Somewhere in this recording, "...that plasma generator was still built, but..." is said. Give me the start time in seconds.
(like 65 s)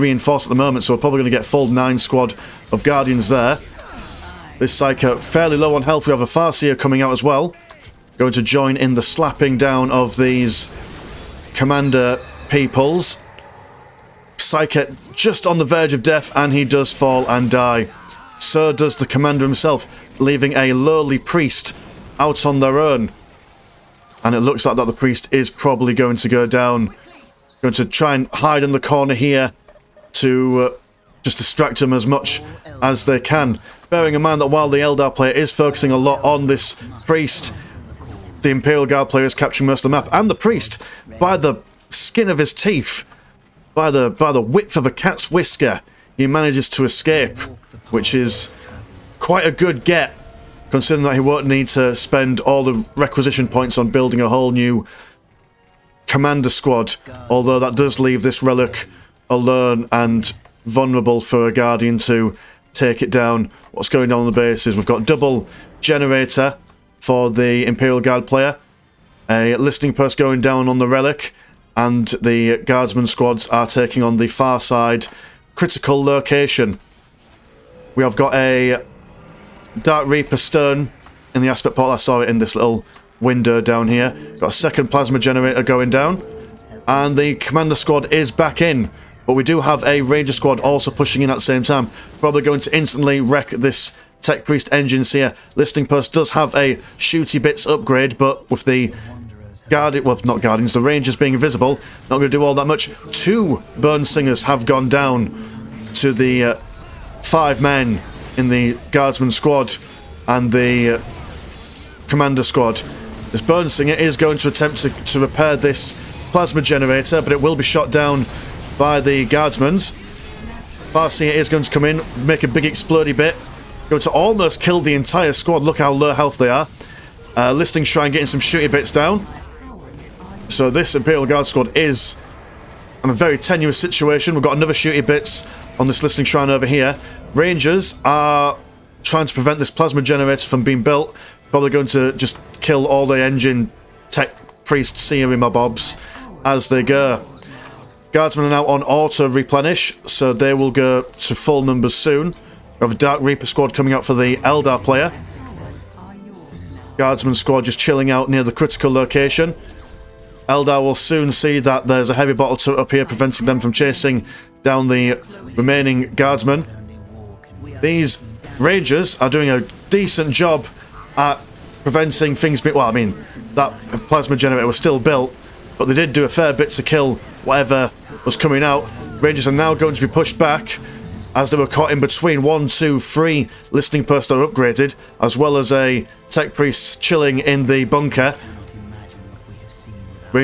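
173 s.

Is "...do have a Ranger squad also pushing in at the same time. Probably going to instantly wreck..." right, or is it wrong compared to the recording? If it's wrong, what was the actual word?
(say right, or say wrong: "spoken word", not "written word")
right.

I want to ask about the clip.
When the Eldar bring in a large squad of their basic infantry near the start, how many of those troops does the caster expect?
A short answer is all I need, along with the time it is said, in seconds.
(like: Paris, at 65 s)
9, at 1 s.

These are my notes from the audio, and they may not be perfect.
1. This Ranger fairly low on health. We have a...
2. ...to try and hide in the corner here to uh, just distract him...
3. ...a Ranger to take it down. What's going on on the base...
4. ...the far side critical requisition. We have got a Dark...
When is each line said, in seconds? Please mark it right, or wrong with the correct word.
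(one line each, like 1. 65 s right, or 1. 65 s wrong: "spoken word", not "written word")
1. 4 s wrong: "Psyker", not "Ranger"
2. 27 s right
3. 61 s wrong: "Guardian", not "Ranger"
4. 74 s wrong: "location", not "requisition".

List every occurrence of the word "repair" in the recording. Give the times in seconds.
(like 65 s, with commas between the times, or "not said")
115 s.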